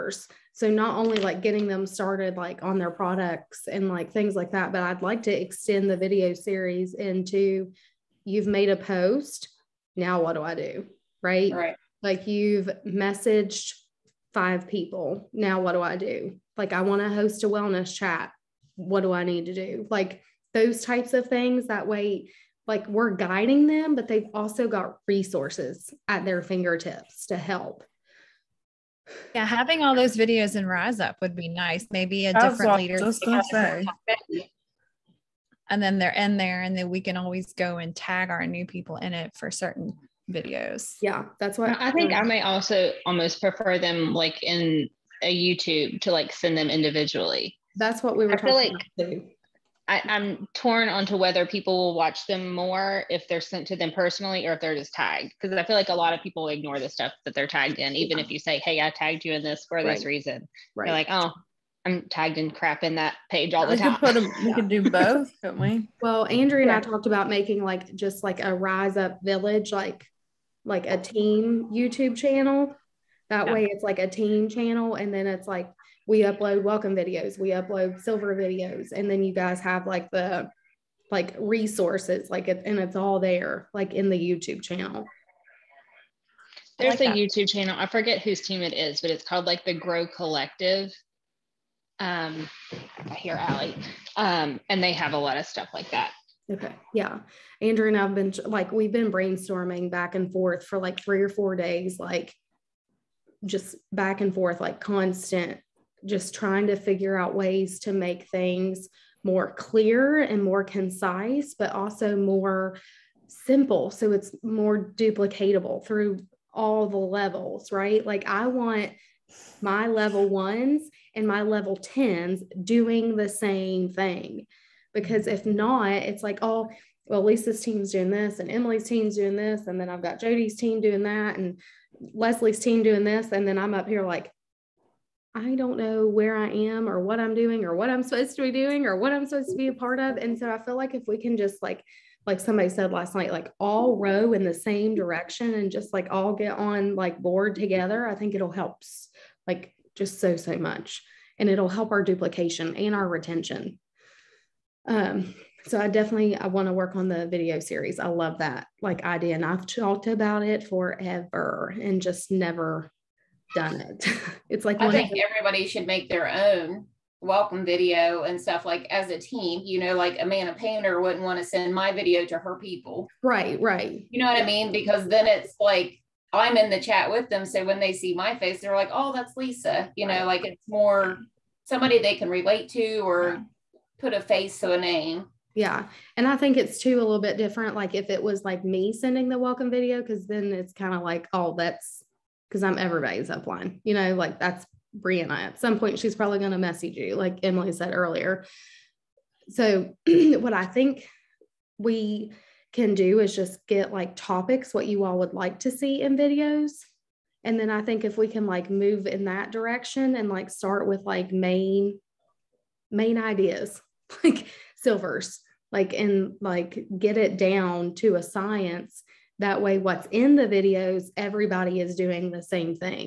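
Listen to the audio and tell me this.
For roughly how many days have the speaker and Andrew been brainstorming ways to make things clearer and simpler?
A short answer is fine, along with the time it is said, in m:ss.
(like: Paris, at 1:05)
3 or 4 days, at 1:40.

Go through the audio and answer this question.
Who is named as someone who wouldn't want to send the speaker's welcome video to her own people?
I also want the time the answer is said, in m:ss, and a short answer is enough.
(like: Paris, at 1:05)
Amanda Painter, at 2:50.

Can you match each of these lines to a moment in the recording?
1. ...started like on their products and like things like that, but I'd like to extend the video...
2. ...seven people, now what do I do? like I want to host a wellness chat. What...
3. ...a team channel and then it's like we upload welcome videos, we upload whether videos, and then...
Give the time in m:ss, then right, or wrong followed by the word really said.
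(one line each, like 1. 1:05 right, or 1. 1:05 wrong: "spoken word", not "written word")
1. 0:01 right
2. 0:14 wrong: "five", not "seven"
3. 1:13 wrong: "silver", not "whether".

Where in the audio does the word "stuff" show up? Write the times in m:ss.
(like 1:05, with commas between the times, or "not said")
0:56, 1:35, 2:48.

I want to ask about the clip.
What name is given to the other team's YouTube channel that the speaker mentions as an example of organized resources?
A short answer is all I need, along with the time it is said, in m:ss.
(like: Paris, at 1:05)
the Grow Collective, at 1:29.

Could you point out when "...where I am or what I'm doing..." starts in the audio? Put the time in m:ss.
2:16.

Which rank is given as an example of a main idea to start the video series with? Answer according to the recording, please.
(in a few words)
silvers.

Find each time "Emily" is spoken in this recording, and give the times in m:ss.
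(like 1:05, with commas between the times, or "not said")
2:08, 3:17.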